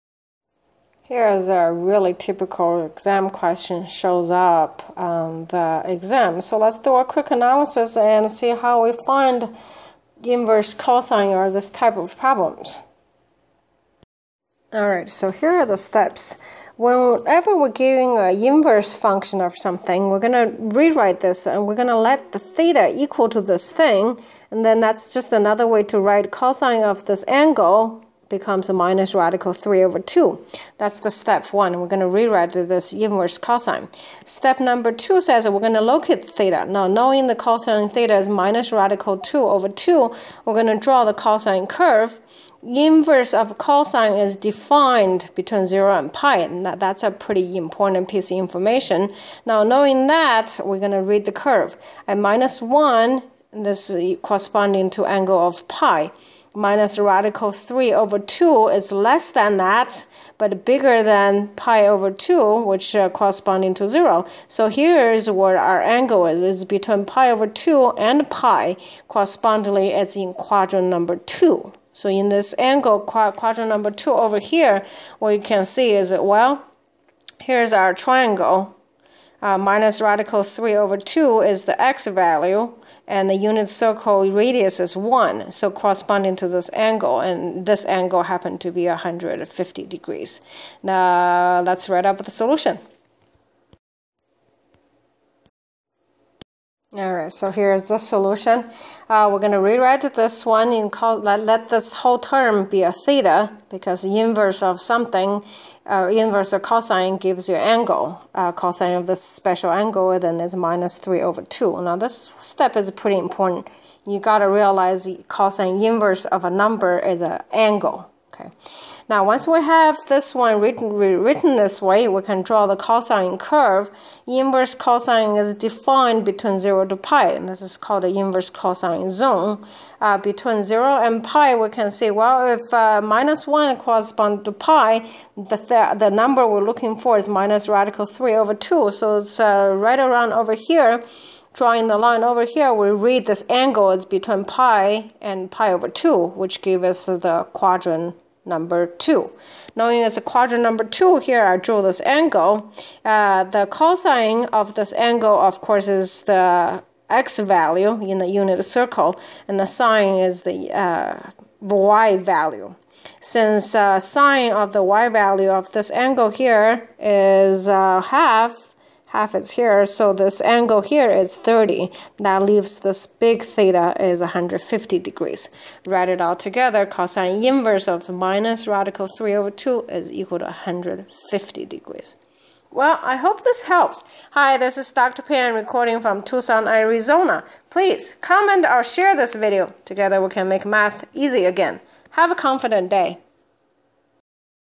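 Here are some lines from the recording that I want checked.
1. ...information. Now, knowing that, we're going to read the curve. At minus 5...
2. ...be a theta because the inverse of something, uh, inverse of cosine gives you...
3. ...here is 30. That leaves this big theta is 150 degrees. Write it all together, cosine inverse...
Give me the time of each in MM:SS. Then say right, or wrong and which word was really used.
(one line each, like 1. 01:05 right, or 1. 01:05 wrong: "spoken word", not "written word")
1. 00:48 wrong: "1", not "5"
2. 01:42 right
3. 02:50 right.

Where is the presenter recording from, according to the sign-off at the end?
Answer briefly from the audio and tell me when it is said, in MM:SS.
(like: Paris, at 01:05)
Tucson, Arizona, at 03:06.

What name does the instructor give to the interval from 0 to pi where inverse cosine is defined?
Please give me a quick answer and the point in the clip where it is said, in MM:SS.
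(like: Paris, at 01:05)
inverse cosine zone, at 02:08.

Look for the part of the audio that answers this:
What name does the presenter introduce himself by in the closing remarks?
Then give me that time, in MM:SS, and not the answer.
03:04.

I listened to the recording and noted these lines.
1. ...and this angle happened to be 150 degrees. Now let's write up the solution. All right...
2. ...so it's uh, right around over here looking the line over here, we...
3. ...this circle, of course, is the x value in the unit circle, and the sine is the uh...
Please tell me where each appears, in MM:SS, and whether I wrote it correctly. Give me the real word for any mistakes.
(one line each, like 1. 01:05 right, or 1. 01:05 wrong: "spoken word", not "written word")
1. 01:27 right
2. 02:18 wrong: "drawing", not "looking"
3. 02:34 wrong: "angle", not "circle".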